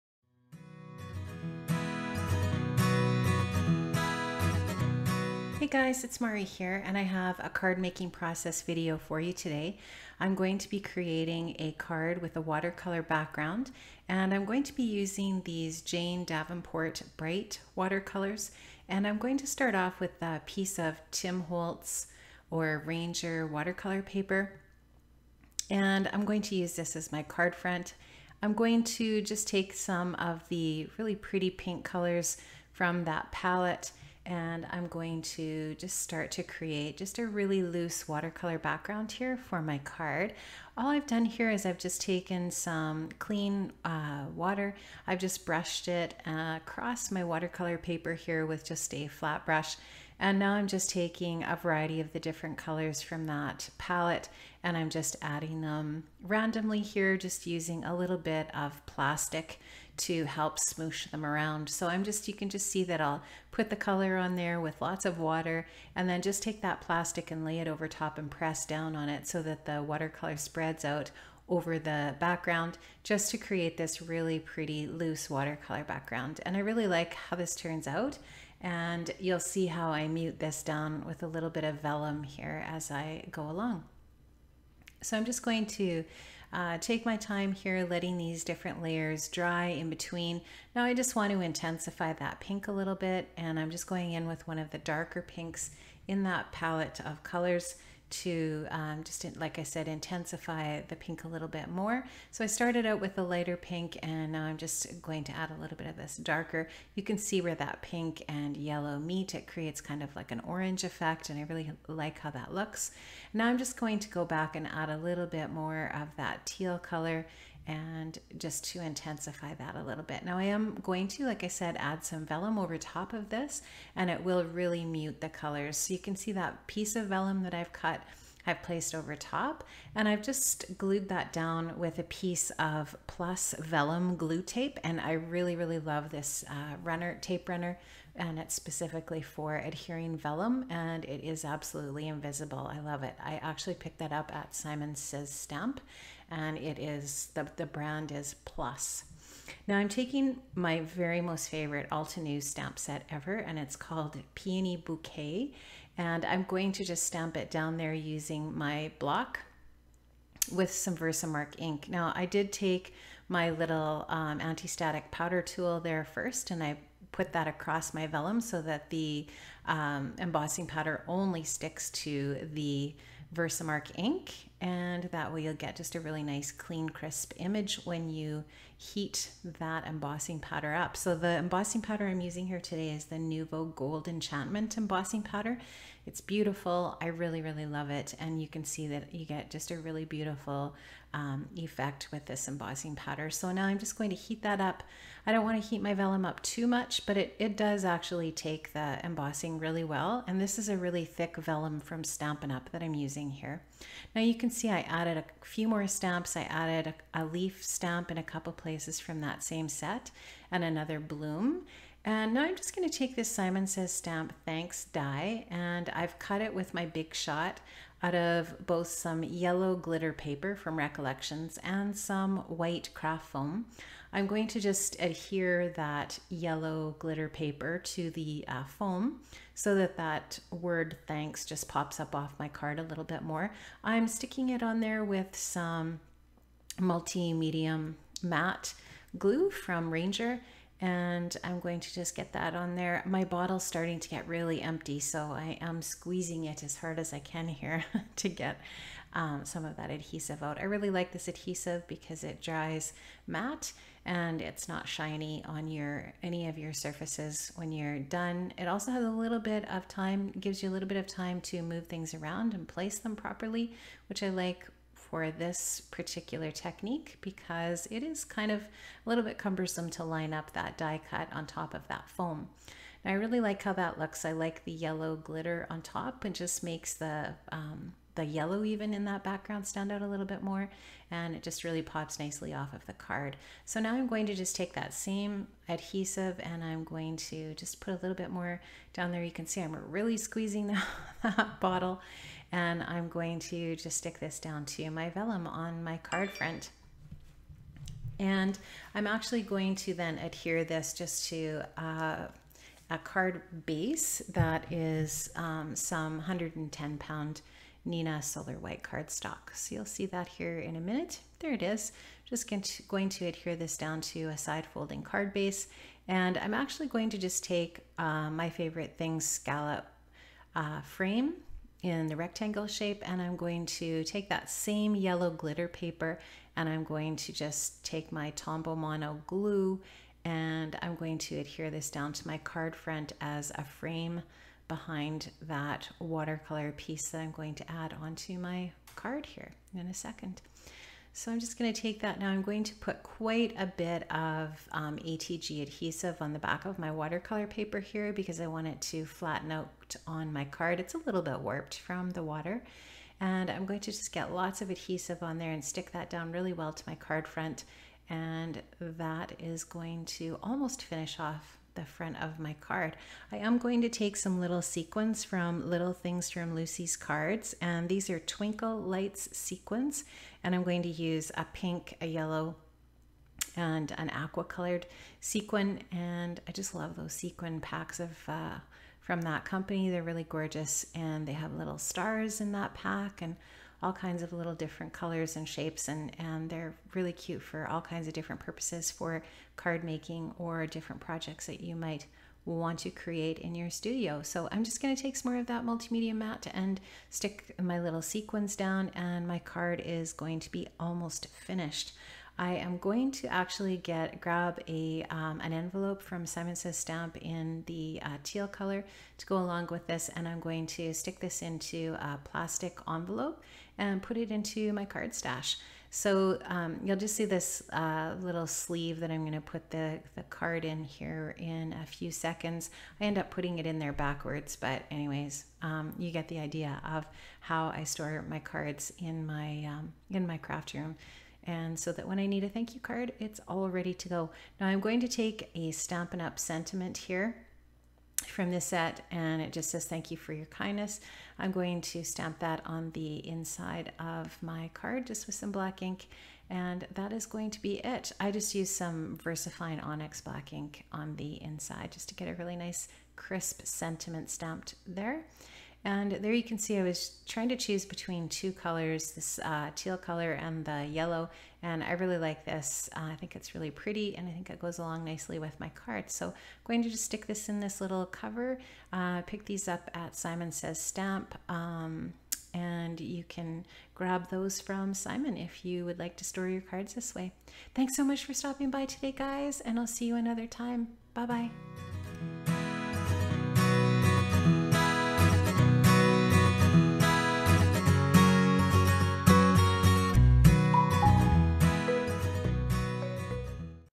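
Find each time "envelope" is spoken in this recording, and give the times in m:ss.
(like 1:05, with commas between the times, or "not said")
6:45, 6:52.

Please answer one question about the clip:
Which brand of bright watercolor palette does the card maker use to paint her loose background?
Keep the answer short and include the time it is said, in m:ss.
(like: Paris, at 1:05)
Jane Davenport, at 0:15.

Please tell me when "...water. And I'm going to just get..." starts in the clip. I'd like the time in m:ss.
5:52.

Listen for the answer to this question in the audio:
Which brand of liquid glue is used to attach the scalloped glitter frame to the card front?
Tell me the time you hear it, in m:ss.
5:28.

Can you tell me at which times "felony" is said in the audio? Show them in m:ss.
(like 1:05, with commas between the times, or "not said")
not said.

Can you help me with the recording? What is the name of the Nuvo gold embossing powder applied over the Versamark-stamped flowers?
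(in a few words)
Gold Enchantment.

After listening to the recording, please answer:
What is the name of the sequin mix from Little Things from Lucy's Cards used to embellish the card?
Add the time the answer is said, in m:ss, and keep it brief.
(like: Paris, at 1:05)
Twinkle Lights, at 6:08.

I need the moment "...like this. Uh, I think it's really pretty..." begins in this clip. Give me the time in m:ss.
7:42.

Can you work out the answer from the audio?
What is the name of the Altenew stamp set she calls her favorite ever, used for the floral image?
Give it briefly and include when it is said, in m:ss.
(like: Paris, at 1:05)
Peony Bouquet, at 2:34.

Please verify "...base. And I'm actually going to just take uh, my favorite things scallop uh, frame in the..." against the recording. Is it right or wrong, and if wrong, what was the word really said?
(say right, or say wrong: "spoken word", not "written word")
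right.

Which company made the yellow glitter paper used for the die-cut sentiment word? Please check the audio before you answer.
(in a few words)
Recollections.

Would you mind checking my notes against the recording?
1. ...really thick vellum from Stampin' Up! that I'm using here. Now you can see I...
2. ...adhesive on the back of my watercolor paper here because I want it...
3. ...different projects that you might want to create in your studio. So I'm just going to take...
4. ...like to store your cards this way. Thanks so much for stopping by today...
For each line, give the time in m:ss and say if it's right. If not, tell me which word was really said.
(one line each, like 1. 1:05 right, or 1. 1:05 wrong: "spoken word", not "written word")
1. 3:20 right
2. 5:45 right
3. 6:30 right
4. 7:55 right.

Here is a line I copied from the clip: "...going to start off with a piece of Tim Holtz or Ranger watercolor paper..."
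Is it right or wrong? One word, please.
right.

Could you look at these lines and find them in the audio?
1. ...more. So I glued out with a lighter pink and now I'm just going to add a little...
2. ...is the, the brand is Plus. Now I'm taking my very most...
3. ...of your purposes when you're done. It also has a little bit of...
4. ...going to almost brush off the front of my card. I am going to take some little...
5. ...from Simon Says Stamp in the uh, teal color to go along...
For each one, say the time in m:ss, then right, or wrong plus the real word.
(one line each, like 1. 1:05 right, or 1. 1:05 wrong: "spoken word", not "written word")
1. 1:41 wrong: "started", not "glued"
2. 2:26 right
3. 4:16 wrong: "surfaces", not "purposes"
4. 5:59 wrong: "finish", not "brush"
5. 6:46 right.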